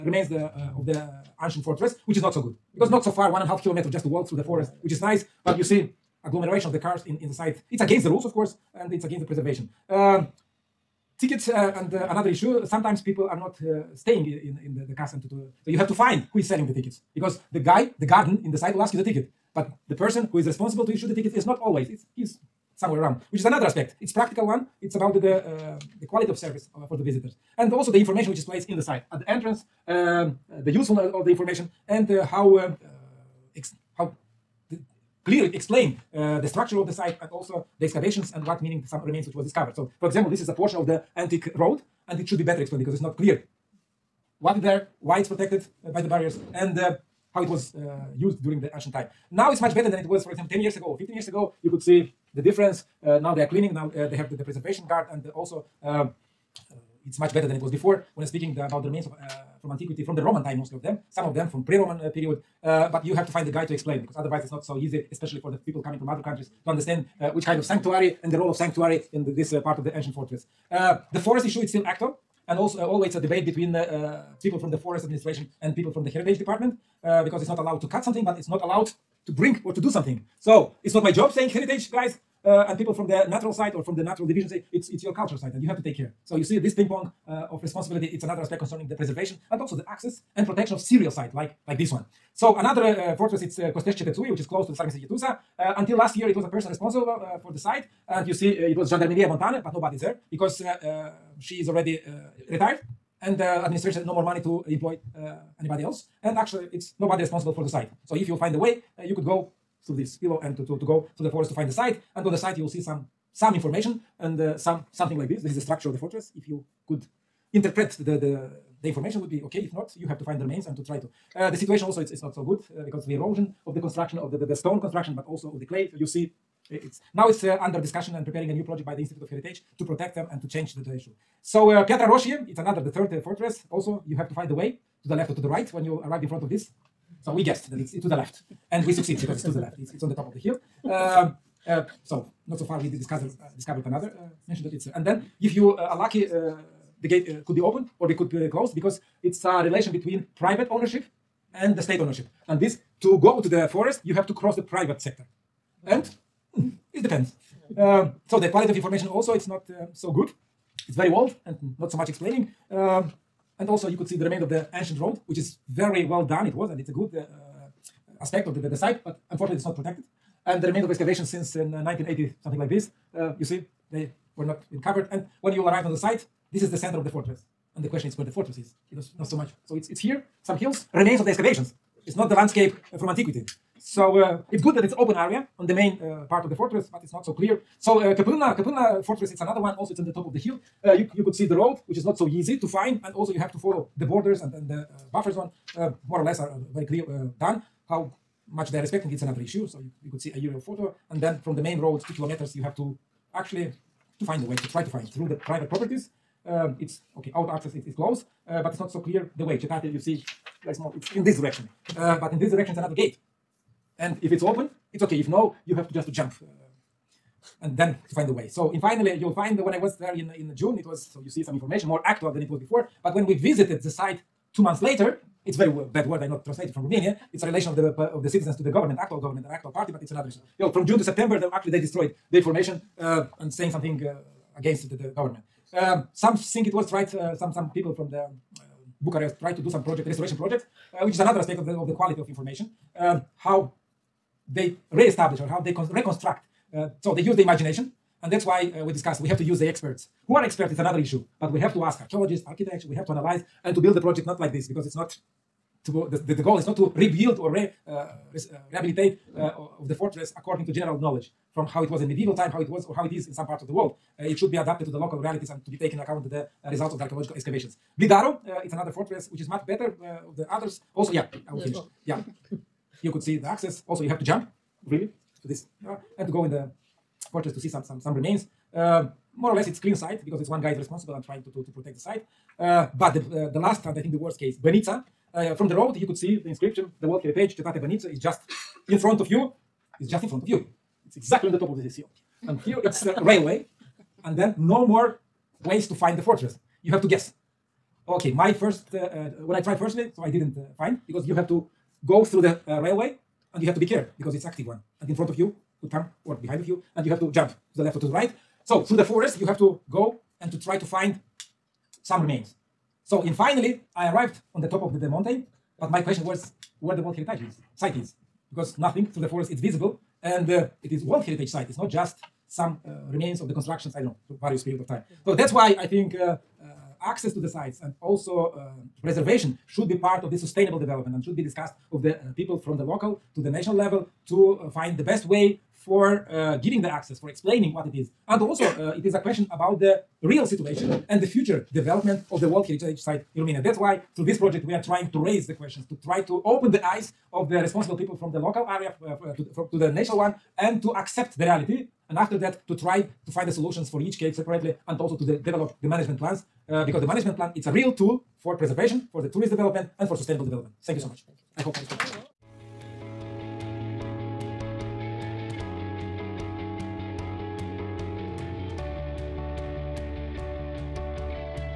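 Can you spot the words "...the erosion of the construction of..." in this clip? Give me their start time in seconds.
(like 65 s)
123 s.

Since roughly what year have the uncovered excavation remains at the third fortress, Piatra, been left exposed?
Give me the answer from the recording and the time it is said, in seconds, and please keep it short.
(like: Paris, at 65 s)
1980, at 171 s.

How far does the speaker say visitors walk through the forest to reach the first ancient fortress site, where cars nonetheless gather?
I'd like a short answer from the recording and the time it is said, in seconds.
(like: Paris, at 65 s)
1.5 kilometers, at 3 s.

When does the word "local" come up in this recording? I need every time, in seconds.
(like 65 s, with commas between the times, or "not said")
264 s, 332 s, 348 s.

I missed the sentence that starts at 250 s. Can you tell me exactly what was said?
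Who are experts is another issue.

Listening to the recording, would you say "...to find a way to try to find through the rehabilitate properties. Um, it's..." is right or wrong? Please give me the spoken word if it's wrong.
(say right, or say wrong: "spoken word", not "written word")
wrong: "private", not "rehabilitate".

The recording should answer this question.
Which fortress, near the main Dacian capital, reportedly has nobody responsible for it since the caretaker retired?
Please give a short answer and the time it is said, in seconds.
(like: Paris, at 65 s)
Costești, at 93 s.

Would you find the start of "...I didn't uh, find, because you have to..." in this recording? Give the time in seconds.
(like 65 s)
300 s.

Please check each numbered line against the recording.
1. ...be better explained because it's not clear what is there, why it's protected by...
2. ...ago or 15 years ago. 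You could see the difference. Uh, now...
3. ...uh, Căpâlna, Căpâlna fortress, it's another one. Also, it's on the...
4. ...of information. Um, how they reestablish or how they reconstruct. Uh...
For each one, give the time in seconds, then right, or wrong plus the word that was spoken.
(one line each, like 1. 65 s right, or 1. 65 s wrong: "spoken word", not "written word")
1. 42 s right
2. 50 s right
3. 188 s right
4. 242 s right.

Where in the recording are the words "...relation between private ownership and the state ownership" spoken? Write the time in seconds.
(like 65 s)
149 s.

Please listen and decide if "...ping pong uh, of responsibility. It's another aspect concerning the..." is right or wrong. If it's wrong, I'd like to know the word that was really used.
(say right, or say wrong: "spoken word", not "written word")
right.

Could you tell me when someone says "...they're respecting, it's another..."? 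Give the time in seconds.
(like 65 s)
198 s.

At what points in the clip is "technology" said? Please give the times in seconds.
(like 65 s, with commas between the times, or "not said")
not said.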